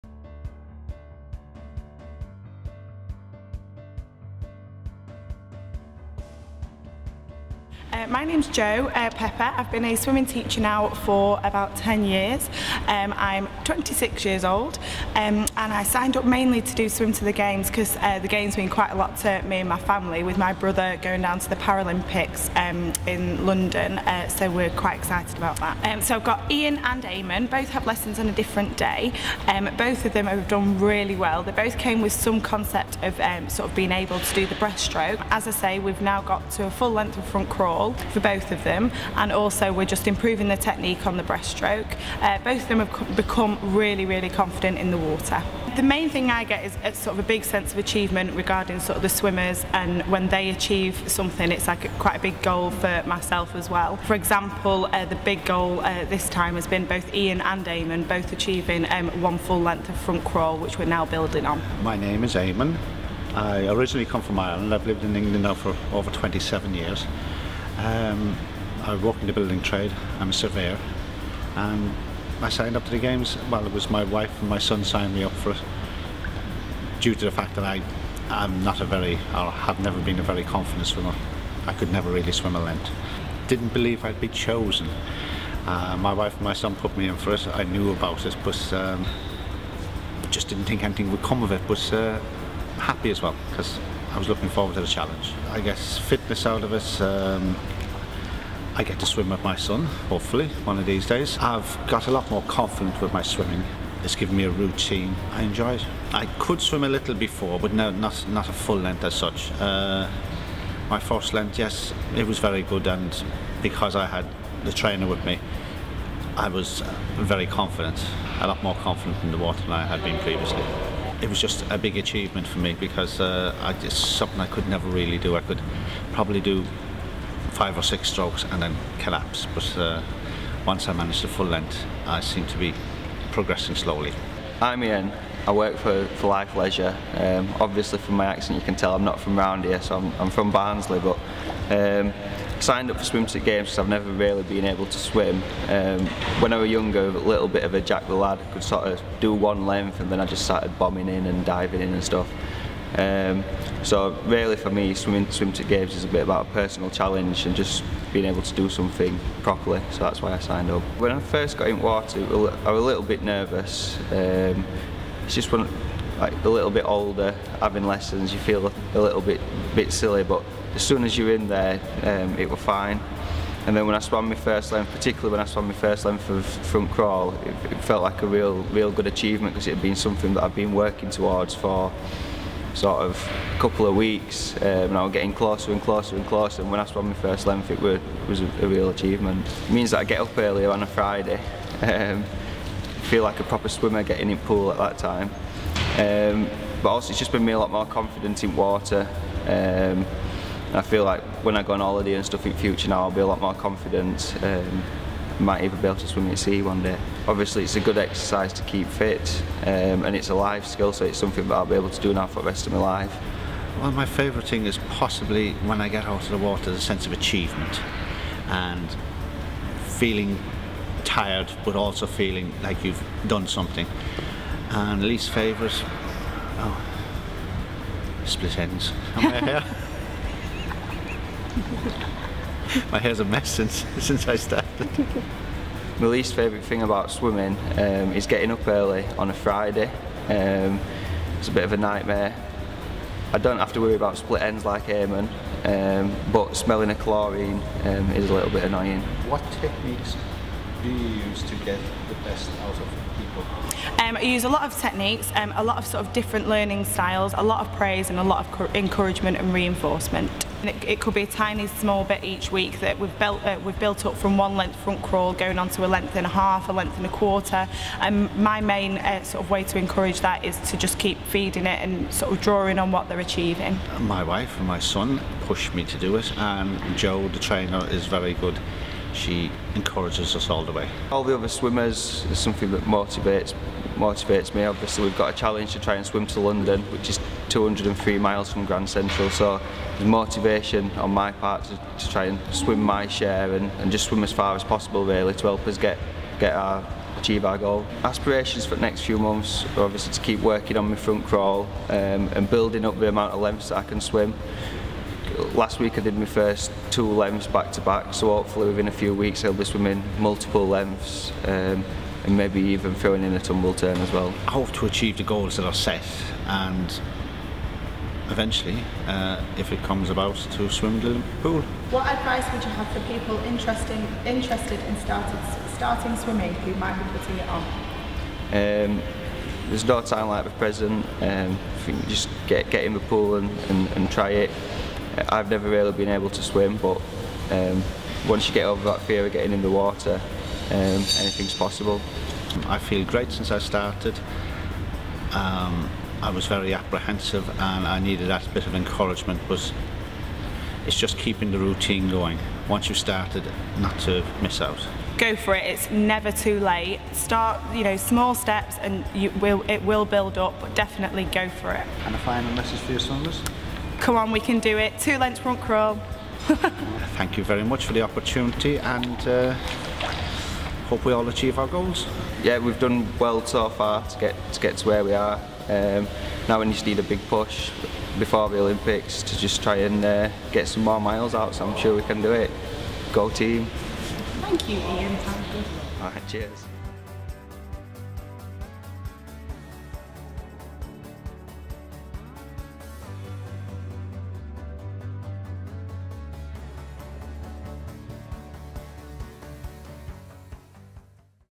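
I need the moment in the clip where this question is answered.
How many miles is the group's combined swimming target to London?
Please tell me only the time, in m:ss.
4:47.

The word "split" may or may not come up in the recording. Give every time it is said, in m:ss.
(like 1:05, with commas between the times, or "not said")
3:48, 4:04.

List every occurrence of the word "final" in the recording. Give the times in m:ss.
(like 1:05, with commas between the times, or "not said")
6:02.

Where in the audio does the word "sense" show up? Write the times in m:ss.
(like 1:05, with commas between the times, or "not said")
0:47, 3:36.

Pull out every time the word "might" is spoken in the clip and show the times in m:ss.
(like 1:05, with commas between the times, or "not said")
3:25, 5:26.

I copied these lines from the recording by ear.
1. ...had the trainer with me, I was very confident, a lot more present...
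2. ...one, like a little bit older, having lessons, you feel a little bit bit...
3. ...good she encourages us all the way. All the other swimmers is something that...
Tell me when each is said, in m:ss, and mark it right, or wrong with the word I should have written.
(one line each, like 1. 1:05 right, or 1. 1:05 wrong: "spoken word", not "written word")
1. 1:54 wrong: "confident", not "present"
2. 2:45 right
3. 4:38 right.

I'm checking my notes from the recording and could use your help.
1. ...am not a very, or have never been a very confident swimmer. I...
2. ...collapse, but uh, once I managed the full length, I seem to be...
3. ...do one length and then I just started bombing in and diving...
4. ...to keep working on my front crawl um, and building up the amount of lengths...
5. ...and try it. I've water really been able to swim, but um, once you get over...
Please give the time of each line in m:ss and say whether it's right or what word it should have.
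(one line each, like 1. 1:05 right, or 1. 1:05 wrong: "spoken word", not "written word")
1. 1:18 right
2. 2:08 right
3. 2:29 right
4. 5:00 right
5. 5:33 wrong: "never", not "water".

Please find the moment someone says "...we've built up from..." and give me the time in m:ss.
4:23.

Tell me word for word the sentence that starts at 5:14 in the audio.
I hope to achieve the goals that are set and eventually, uh, if it comes about, to swim in pool.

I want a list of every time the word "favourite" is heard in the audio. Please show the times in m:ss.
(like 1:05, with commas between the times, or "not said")
3:34, 3:45, 3:56.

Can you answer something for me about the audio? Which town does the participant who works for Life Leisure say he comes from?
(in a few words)
Barnsley.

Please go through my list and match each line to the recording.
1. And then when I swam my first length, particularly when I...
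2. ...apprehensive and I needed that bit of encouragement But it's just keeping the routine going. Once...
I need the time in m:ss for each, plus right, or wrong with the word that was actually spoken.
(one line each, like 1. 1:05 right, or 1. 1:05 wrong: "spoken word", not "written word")
1. 2:53 right
2. 5:46 right.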